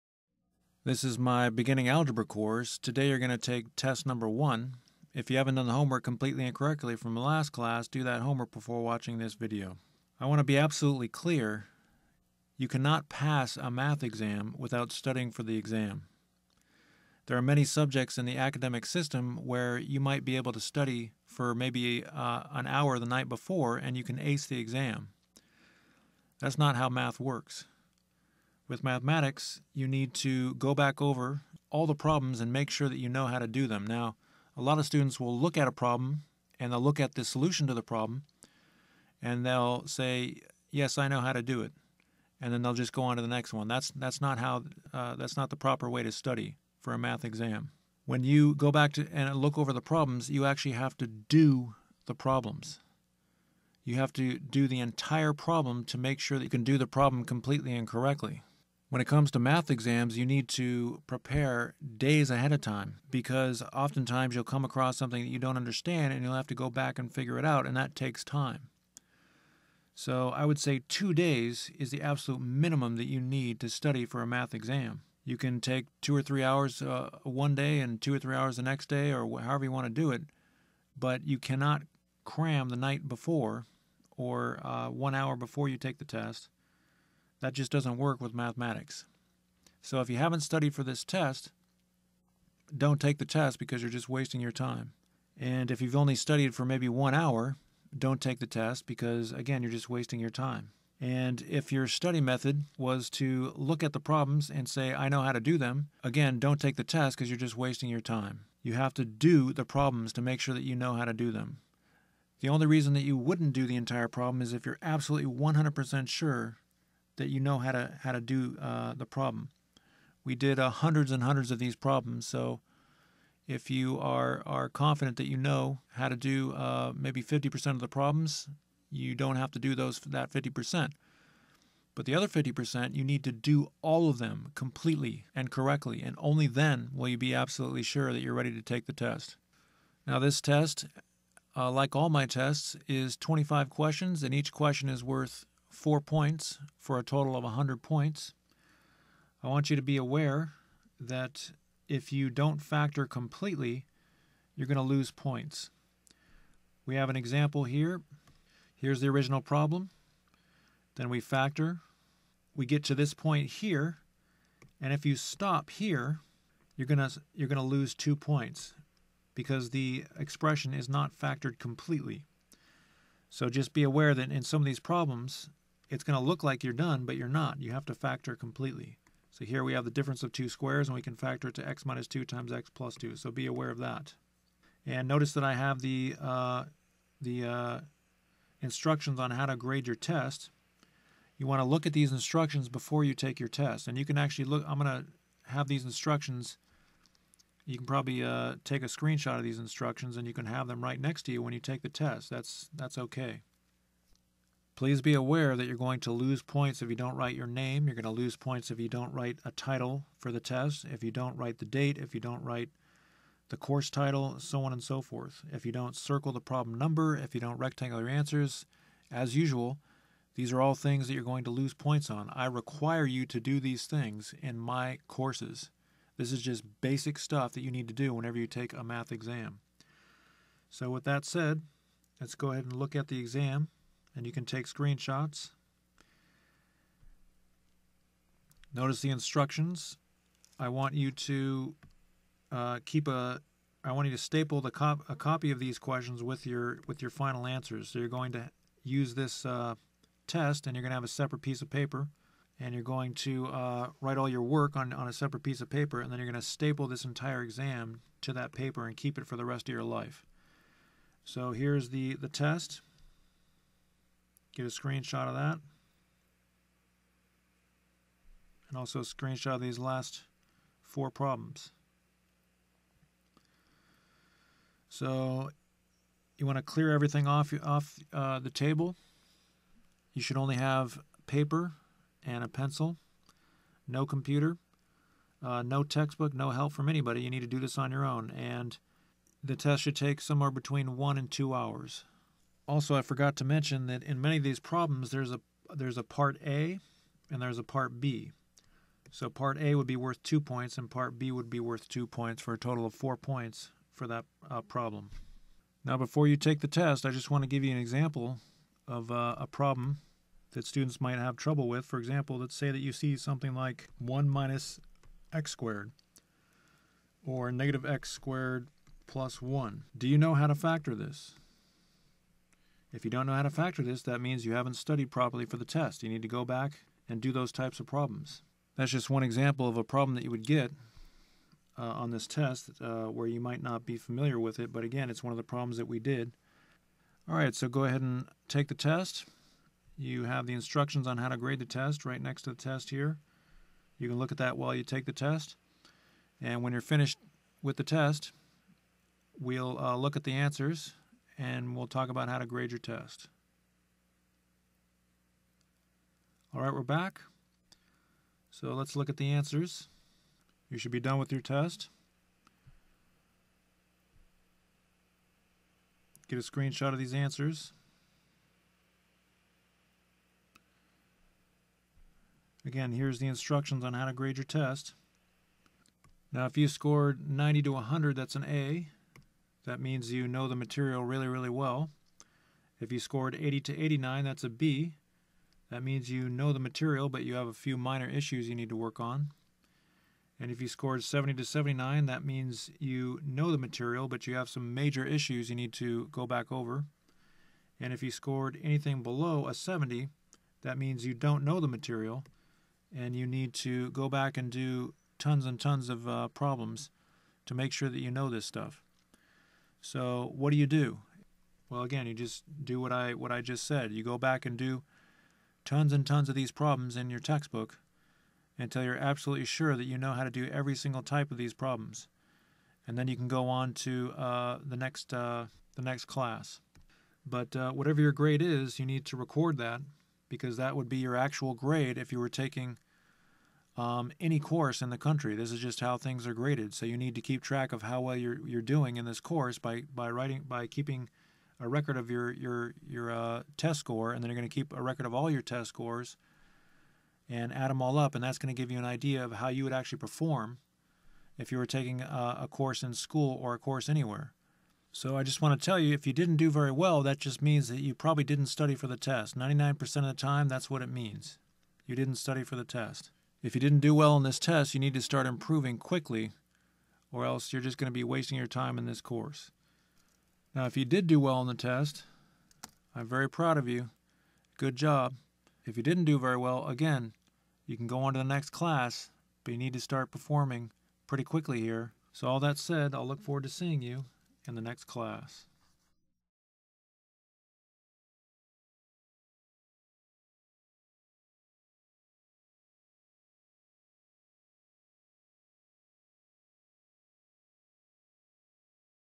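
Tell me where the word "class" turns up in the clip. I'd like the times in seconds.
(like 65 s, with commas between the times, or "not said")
7 s, 426 s, 478 s, 484 s.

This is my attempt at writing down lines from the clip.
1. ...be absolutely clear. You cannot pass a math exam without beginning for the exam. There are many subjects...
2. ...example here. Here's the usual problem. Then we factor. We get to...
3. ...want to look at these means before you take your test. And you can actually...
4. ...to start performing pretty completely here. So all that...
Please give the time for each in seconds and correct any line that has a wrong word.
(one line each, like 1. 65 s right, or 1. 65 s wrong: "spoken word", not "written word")
1. 10 s wrong: "studying", not "beginning"
2. 157 s wrong: "original", not "usual"
3. 191 s wrong: "instructions", not "means"
4. 479 s wrong: "quickly", not "completely".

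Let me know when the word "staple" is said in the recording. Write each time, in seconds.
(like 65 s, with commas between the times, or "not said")
244 s, 256 s.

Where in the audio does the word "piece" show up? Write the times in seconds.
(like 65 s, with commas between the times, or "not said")
251 s, 255 s.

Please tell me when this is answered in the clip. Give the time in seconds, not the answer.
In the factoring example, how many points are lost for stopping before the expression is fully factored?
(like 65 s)
167 s.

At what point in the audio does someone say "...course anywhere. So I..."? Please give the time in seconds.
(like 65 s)
453 s.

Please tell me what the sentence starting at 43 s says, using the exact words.
That's that's not how uh, that's not the proper way to study for a math exam.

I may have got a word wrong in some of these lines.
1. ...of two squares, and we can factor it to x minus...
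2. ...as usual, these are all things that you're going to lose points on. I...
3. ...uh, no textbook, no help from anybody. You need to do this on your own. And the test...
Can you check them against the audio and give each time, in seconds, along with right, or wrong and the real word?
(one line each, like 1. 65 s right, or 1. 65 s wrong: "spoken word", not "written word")
1. 180 s right
2. 219 s right
3. 285 s right.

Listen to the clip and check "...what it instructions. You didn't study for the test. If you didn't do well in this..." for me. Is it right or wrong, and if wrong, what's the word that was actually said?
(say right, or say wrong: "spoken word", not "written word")
wrong: "means", not "instructions".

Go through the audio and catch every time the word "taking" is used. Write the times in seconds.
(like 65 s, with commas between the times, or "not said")
432 s, 451 s.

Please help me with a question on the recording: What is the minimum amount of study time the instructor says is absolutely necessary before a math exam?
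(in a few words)
2 days.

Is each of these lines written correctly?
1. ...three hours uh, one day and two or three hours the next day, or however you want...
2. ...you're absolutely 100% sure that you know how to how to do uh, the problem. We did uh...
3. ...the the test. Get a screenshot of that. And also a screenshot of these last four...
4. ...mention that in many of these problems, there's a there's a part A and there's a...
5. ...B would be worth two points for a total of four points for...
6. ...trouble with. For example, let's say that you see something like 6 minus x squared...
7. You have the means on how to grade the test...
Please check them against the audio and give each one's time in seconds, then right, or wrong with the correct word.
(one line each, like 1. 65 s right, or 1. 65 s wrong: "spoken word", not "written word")
1. 76 s right
2. 114 s right
3. 261 s right
4. 293 s right
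5. 301 s right
6. 311 s wrong: "1", not "6"
7. 339 s wrong: "instructions", not "means".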